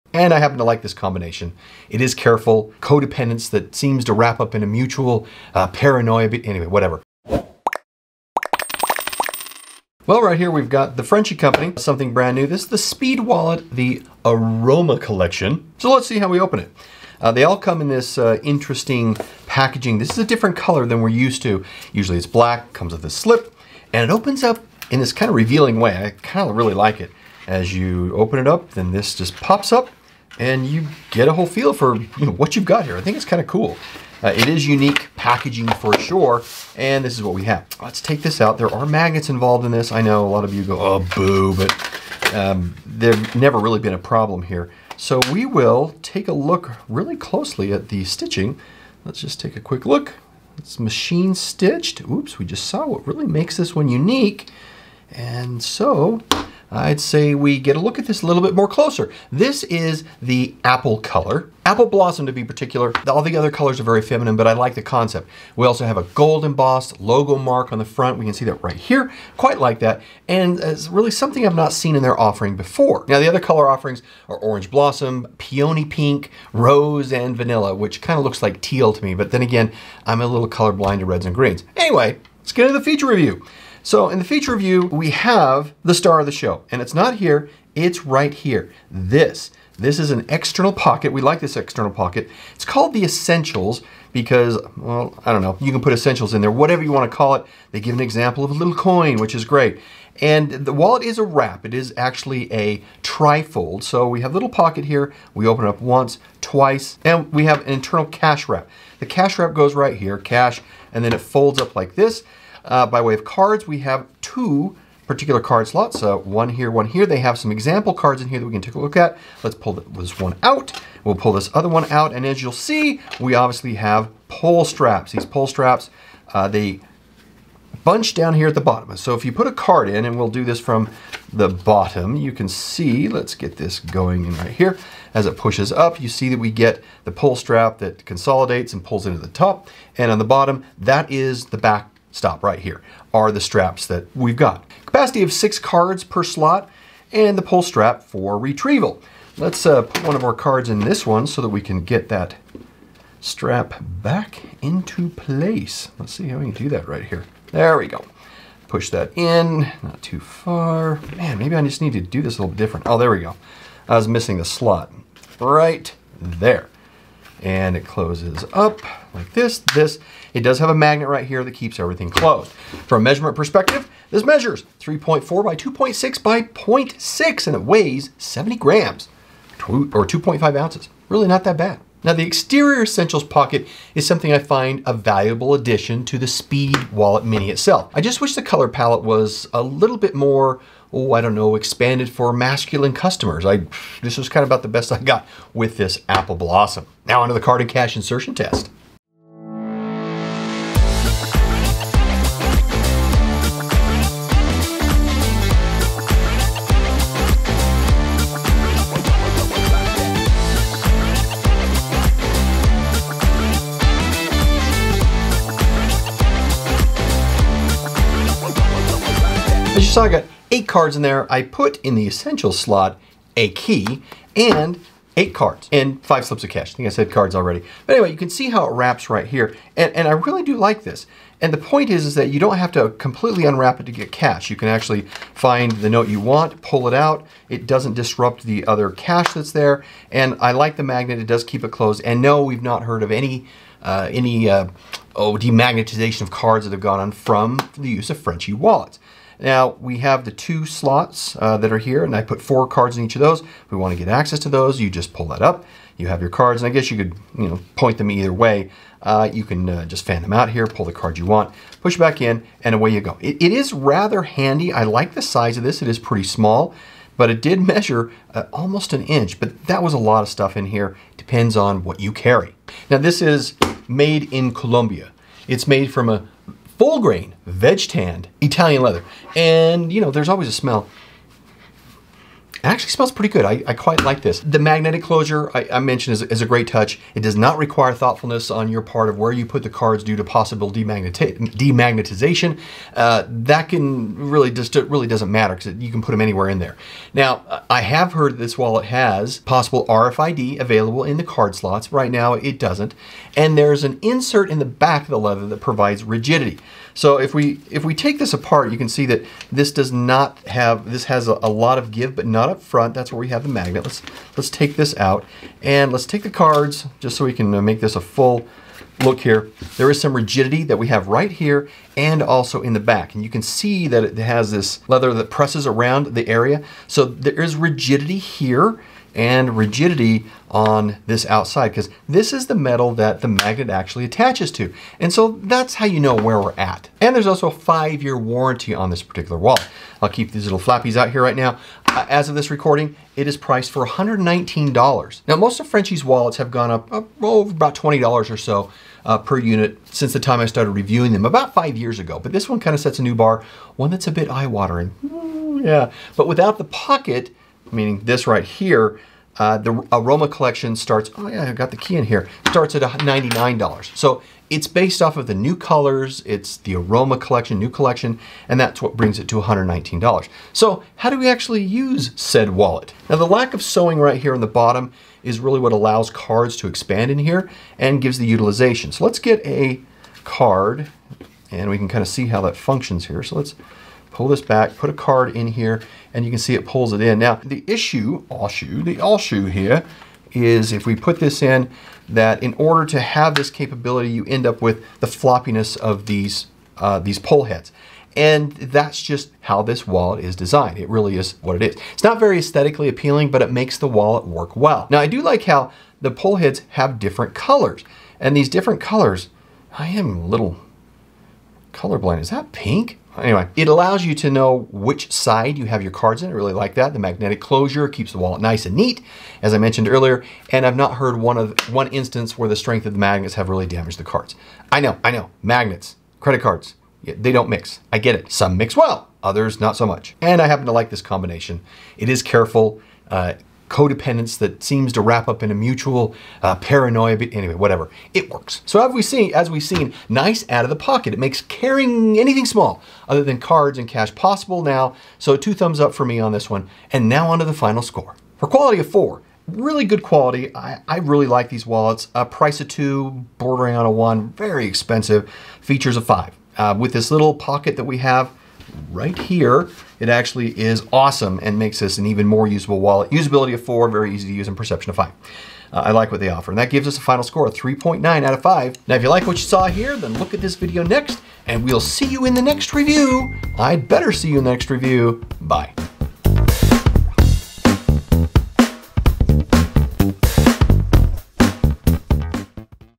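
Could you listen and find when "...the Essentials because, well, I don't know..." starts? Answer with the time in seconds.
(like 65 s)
92 s.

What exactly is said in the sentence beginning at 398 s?
And that's just how this wallet is designed.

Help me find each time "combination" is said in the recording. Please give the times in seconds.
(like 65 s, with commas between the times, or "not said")
0 s, 431 s.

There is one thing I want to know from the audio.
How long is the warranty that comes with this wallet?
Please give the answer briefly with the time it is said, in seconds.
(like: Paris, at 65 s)
5 years, at 337 s.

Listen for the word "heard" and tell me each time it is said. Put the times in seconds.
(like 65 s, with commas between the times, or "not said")
242 s, 298 s, 420 s.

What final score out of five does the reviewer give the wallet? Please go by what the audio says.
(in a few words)
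3.9.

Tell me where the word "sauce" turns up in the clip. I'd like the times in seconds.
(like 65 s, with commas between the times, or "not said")
not said.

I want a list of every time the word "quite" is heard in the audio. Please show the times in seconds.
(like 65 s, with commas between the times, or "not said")
69 s, 283 s.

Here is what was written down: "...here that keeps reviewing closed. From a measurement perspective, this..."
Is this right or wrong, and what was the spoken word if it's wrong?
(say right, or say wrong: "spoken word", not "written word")
wrong: "everything", not "reviewing".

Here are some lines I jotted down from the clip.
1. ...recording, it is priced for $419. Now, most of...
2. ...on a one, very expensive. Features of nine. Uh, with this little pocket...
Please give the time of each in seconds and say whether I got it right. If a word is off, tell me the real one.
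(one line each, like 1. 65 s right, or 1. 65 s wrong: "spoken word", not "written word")
1. 342 s wrong: "119", not "419"
2. 453 s wrong: "five", not "nine".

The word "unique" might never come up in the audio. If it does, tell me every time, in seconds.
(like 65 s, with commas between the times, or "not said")
34 s, 53 s.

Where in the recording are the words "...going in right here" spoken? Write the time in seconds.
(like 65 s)
133 s.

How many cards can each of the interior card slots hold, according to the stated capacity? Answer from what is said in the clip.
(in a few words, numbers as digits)
6.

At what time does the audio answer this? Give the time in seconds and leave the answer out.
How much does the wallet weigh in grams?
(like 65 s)
178 s.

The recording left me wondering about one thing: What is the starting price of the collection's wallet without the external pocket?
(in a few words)
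$99.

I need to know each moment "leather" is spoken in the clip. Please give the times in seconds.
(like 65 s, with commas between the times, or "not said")
278 s, 305 s, 324 s.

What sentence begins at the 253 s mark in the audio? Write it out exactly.
If we want to get access to those, you just pull that up.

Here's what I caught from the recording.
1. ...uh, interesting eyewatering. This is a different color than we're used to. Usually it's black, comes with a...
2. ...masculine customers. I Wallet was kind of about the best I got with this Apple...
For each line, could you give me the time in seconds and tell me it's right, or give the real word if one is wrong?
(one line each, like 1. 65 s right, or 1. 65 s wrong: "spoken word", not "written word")
1. 18 s wrong: "packaging", not "eyewatering"
2. 192 s wrong: "This", not "Wallet".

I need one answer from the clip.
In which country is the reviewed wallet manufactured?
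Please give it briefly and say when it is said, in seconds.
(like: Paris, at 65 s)
Colombia, at 274 s.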